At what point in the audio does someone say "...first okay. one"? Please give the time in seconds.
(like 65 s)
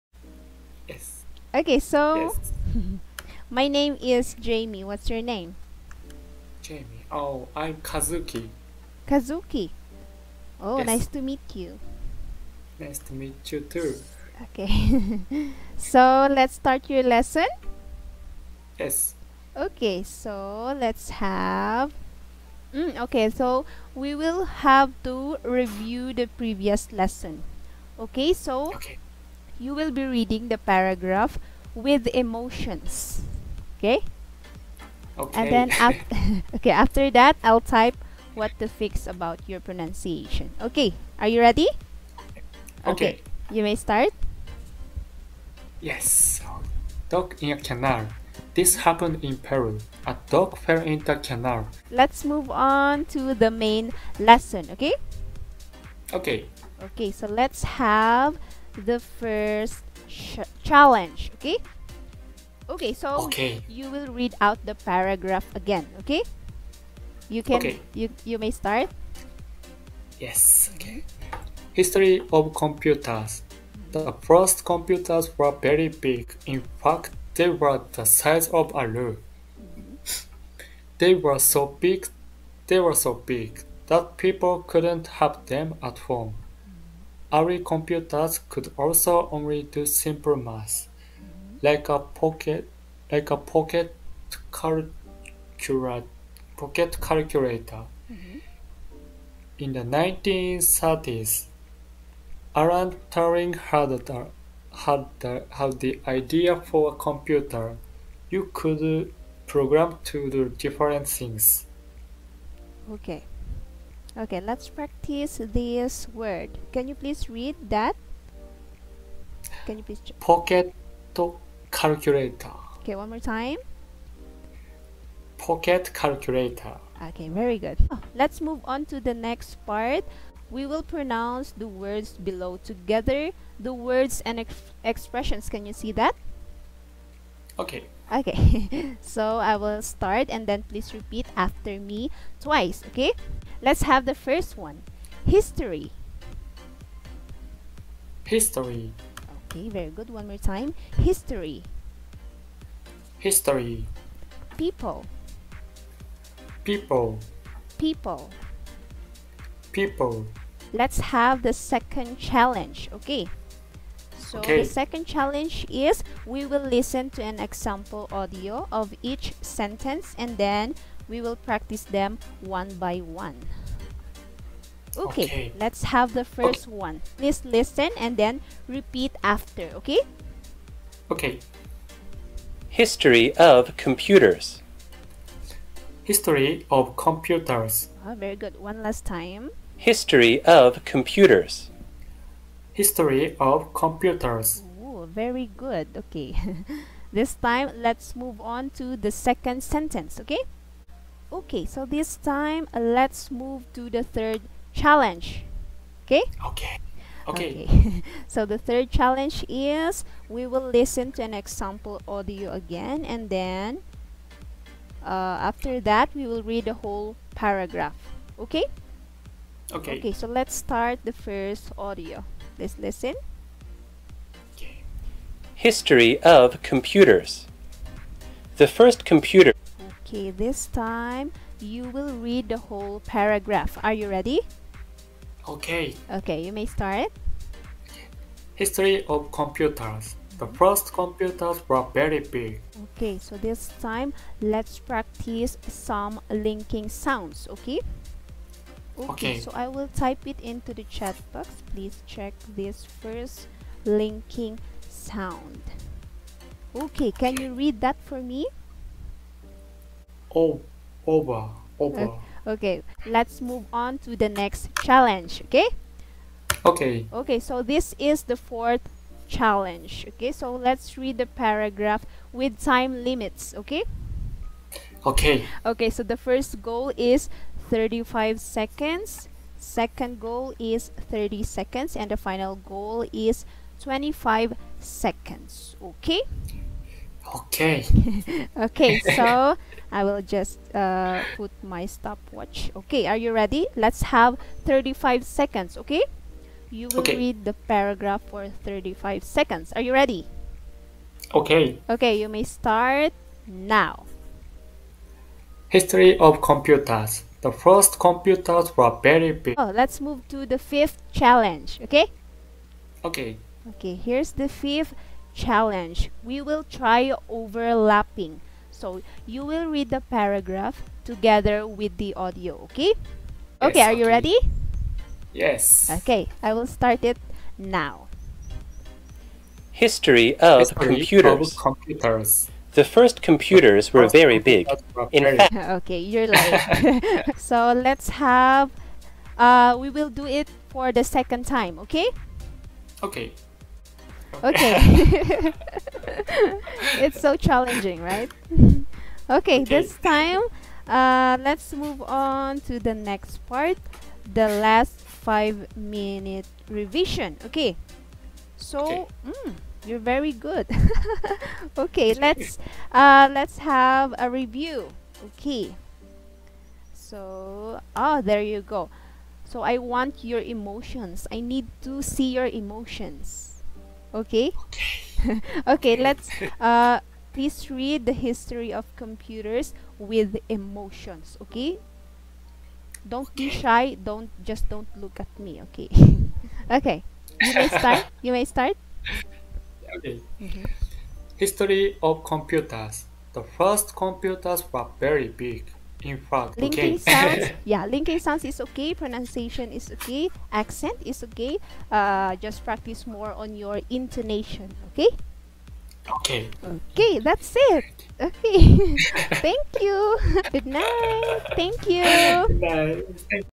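176 s.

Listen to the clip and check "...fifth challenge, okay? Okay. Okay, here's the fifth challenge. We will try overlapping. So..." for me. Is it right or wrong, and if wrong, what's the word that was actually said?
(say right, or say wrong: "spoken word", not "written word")
right.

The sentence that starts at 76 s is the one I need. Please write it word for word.
In fact, they were the size of a room.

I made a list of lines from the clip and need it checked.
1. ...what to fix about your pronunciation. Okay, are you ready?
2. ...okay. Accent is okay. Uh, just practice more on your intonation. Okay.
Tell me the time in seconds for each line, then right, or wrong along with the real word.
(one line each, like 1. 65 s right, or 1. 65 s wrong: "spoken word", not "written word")
1. 38 s right
2. 400 s right.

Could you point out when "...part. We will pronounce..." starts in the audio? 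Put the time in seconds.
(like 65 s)
129 s.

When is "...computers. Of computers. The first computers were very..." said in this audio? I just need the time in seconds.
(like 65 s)
330 s.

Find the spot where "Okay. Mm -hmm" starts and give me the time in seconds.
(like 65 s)
389 s.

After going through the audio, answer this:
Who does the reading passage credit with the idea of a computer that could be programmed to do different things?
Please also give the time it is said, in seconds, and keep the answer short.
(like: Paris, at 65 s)
Alan Turing, at 102 s.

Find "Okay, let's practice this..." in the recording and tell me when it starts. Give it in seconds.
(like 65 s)
114 s.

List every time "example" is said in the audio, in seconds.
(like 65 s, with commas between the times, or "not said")
167 s, 211 s.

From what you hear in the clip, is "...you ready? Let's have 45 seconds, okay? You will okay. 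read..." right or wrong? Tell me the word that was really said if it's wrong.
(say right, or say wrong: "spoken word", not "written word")
wrong: "35", not "45".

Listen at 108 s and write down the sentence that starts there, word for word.
You could program to do different things.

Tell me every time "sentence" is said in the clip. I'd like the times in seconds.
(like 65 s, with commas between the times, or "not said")
169 s, 199 s.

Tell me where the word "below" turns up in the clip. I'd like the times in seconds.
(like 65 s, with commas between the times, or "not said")
132 s.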